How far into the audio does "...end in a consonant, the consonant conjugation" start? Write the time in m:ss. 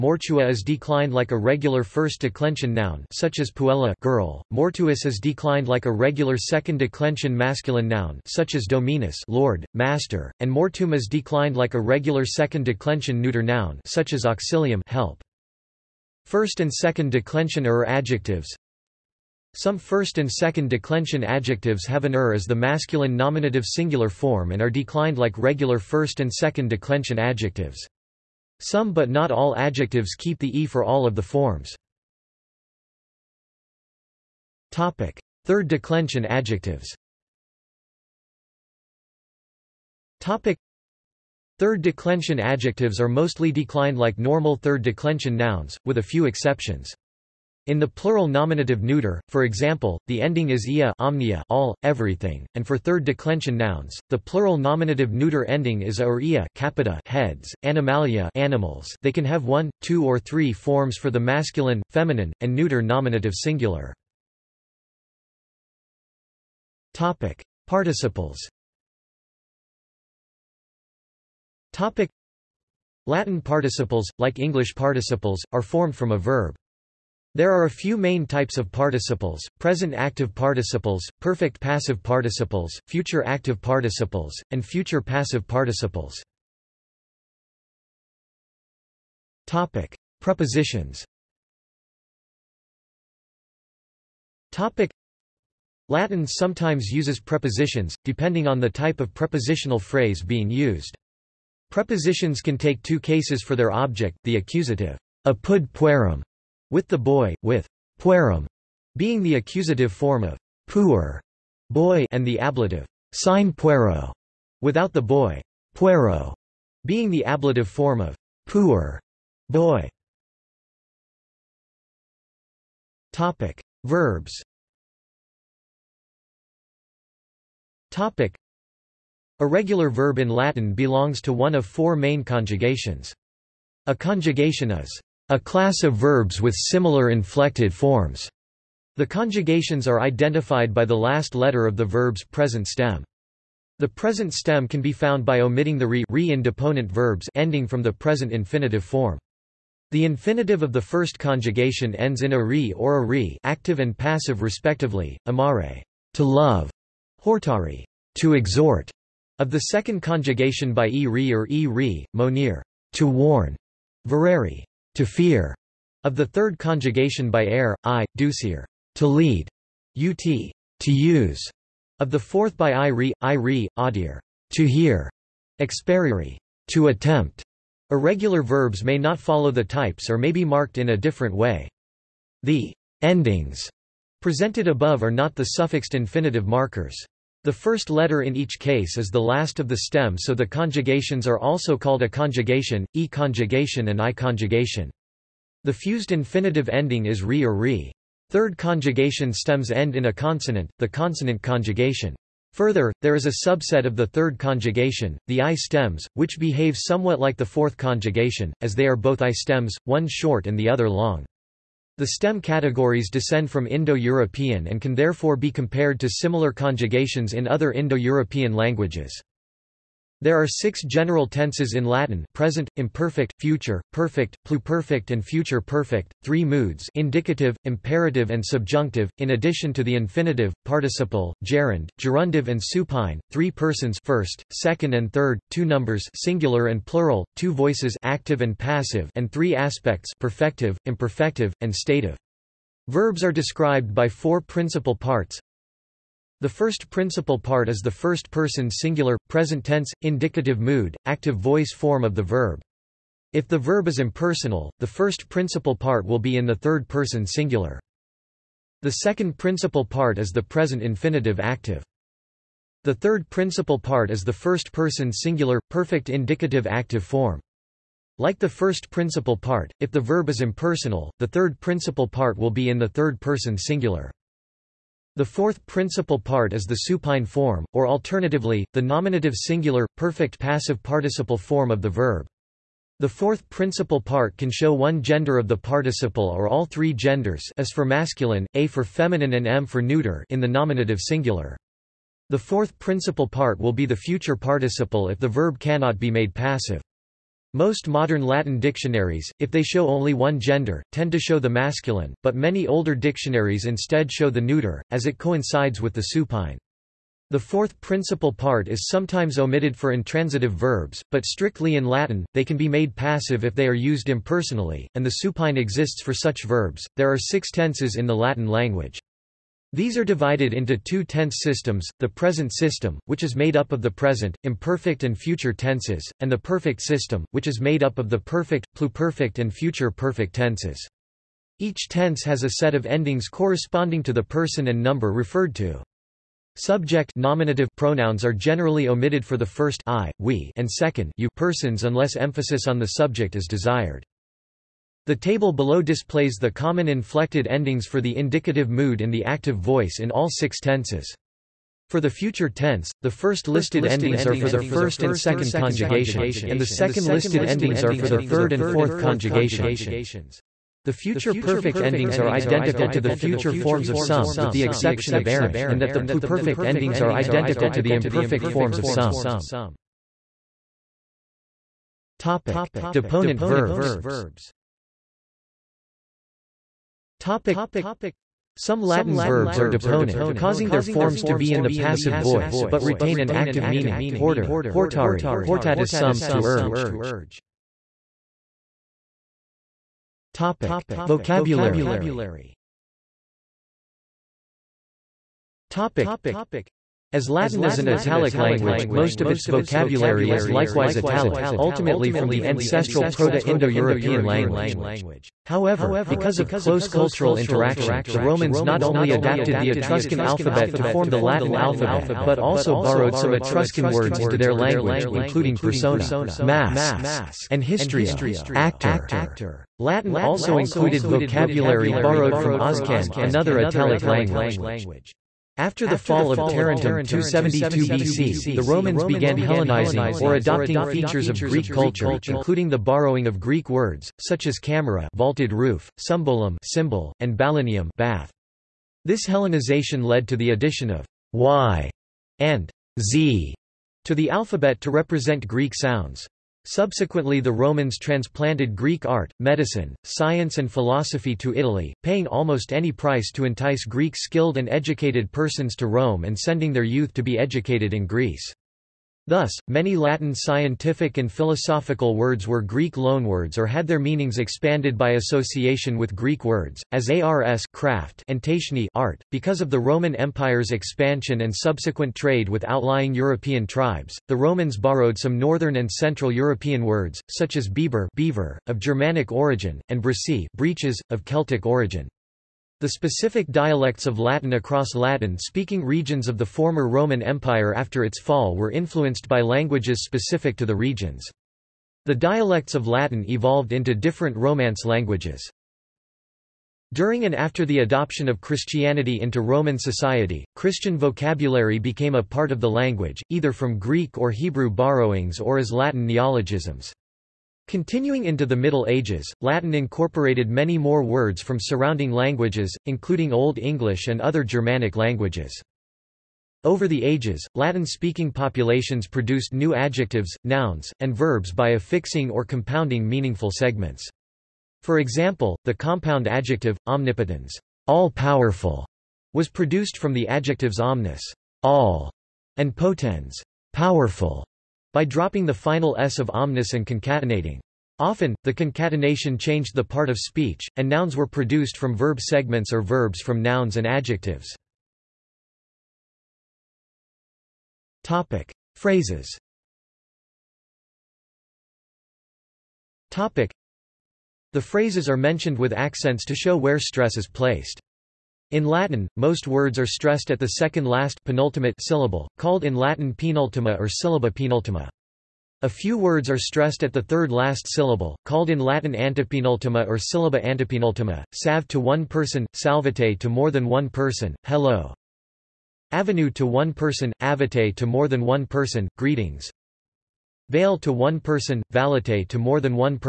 3:19.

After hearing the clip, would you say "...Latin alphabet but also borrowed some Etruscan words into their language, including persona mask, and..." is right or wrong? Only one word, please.
right.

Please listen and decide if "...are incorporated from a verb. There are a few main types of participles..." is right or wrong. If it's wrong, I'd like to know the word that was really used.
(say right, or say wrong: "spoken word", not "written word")
wrong: "formed", not "incorporated".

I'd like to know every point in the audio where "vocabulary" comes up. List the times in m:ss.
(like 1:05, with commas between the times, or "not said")
6:31, 6:39, 7:01, 8:20.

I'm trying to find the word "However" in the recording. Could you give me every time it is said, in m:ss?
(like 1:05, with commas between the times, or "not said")
6:45.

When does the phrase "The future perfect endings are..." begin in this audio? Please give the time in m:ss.
6:00.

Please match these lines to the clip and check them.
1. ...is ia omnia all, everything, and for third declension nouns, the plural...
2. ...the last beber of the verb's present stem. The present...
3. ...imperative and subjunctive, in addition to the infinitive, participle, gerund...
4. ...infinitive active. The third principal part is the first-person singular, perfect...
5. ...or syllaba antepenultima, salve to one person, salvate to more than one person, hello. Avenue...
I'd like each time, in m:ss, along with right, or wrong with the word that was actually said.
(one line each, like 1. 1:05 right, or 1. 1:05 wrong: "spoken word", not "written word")
1. 0:50 right
2. 2:20 wrong: "letter", not "beber"
3. 3:47 right
4. 4:20 right
5. 9:29 right.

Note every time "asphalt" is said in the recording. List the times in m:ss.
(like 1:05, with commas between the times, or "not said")
not said.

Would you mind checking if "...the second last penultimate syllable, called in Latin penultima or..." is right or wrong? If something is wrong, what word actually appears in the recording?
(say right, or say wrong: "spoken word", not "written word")
right.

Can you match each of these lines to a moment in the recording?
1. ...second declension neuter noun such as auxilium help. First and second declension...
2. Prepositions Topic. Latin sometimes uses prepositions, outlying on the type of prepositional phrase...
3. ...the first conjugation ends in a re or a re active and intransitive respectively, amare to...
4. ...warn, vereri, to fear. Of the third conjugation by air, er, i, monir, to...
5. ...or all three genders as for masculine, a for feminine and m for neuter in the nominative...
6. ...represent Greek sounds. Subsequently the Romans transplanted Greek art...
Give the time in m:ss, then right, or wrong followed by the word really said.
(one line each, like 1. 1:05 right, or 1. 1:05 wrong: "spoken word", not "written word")
1. 0:12 right
2. 1:30 wrong: "depending", not "outlying"
3. 2:30 wrong: "passive", not "intransitive"
4. 2:43 wrong: "ducir", not "monir"
5. 4:46 right
6. 7:24 right.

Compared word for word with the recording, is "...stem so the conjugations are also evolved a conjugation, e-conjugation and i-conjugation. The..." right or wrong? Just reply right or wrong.
wrong.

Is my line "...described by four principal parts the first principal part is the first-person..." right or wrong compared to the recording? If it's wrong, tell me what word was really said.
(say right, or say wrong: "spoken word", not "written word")
right.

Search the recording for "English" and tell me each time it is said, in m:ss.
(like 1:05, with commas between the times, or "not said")
1:14, 8:33.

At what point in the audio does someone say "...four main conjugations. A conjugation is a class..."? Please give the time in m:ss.
2:11.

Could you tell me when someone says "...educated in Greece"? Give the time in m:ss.
7:37.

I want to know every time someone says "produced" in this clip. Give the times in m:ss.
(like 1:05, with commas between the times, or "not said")
8:39, 8:49, 9:01.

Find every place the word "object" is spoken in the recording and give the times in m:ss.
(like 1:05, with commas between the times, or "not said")
1:43.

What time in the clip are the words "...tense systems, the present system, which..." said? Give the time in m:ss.
5:21.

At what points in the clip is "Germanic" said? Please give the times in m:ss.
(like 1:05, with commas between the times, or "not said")
7:58, 8:34.